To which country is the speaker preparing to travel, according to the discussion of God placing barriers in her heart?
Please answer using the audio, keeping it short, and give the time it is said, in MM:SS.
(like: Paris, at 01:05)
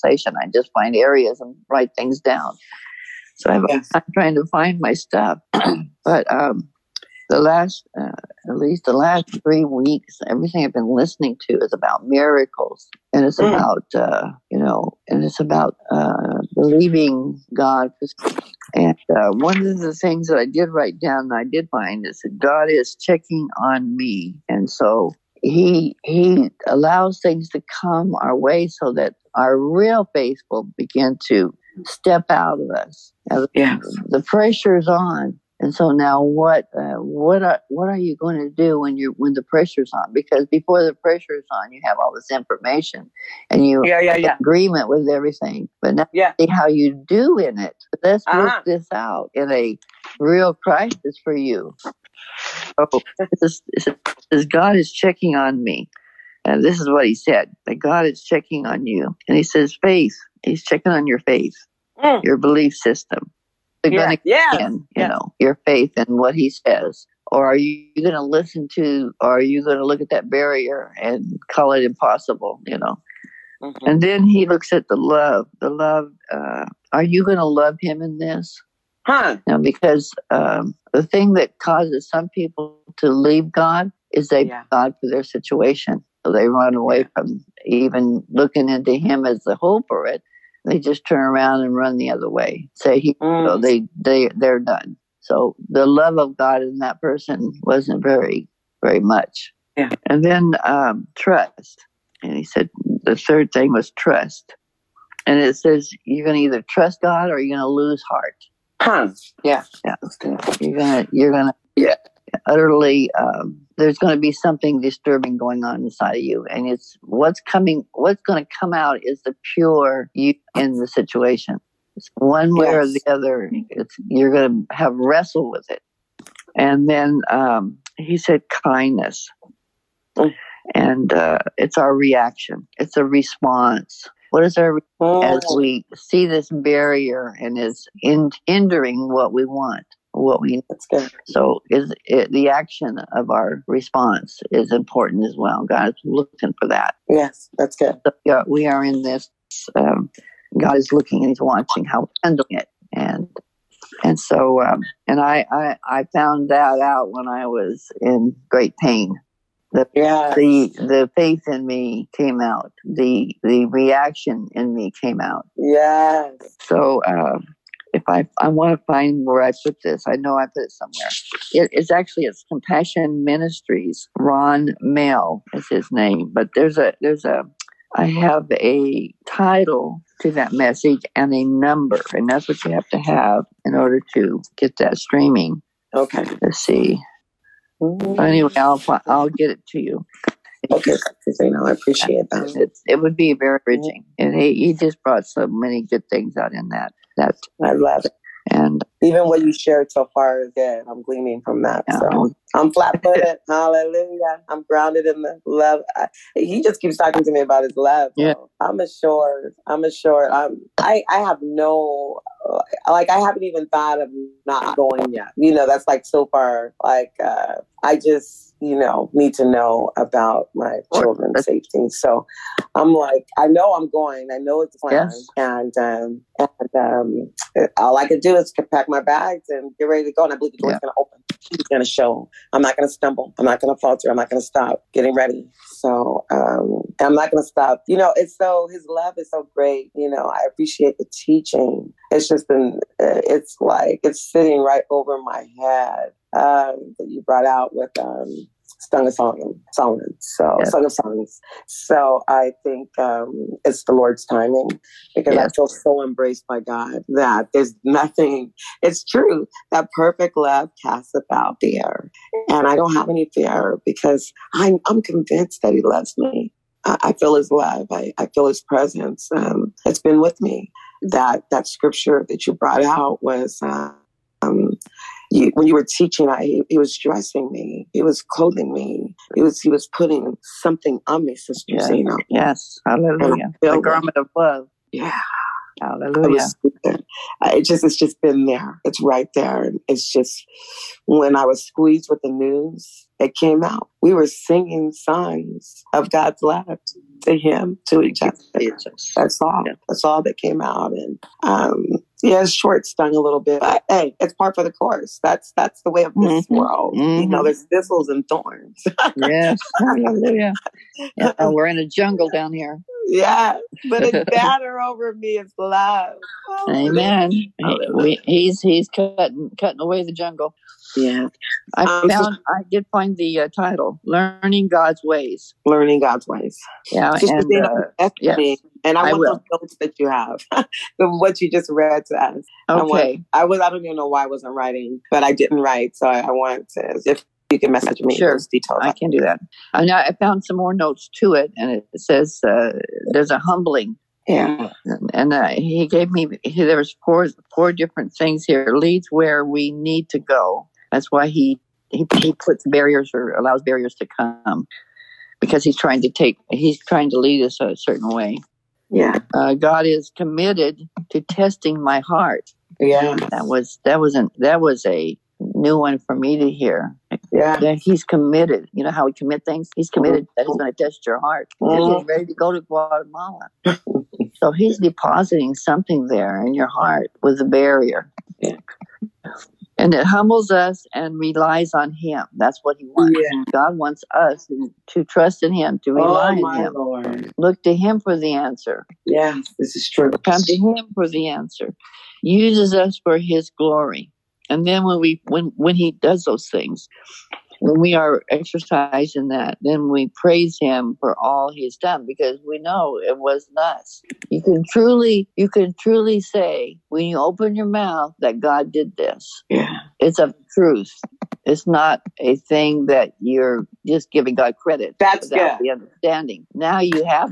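Guatemala, at 06:12.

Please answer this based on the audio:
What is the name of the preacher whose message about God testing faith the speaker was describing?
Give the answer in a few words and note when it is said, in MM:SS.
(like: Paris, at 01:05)
Ron Mail, at 02:54.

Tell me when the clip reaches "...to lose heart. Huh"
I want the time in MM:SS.
01:47.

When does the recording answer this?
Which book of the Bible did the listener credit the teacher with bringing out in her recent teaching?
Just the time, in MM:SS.
04:08.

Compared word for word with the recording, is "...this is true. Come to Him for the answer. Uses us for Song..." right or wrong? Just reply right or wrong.
wrong.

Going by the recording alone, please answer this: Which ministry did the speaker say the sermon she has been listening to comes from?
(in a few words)
Compassion Ministries.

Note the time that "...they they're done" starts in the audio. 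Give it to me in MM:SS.
01:33.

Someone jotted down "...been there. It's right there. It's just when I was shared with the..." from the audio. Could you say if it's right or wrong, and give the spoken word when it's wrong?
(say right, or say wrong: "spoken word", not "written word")
wrong: "squeezed", not "shared".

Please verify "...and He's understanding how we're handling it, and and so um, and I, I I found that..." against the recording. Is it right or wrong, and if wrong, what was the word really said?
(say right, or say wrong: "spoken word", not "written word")
wrong: "watching", not "understanding".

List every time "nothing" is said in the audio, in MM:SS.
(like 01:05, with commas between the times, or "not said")
04:17.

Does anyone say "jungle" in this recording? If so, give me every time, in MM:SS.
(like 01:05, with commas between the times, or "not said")
05:11, 05:20.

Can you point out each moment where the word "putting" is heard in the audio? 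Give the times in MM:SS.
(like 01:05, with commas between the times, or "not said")
04:39.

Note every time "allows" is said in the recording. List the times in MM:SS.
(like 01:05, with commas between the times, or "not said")
00:26, 05:53.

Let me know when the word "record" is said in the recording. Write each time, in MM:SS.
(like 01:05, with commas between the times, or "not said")
not said.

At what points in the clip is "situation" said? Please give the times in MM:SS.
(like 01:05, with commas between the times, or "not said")
01:25, 02:00.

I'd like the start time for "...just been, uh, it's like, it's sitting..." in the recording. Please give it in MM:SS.
04:02.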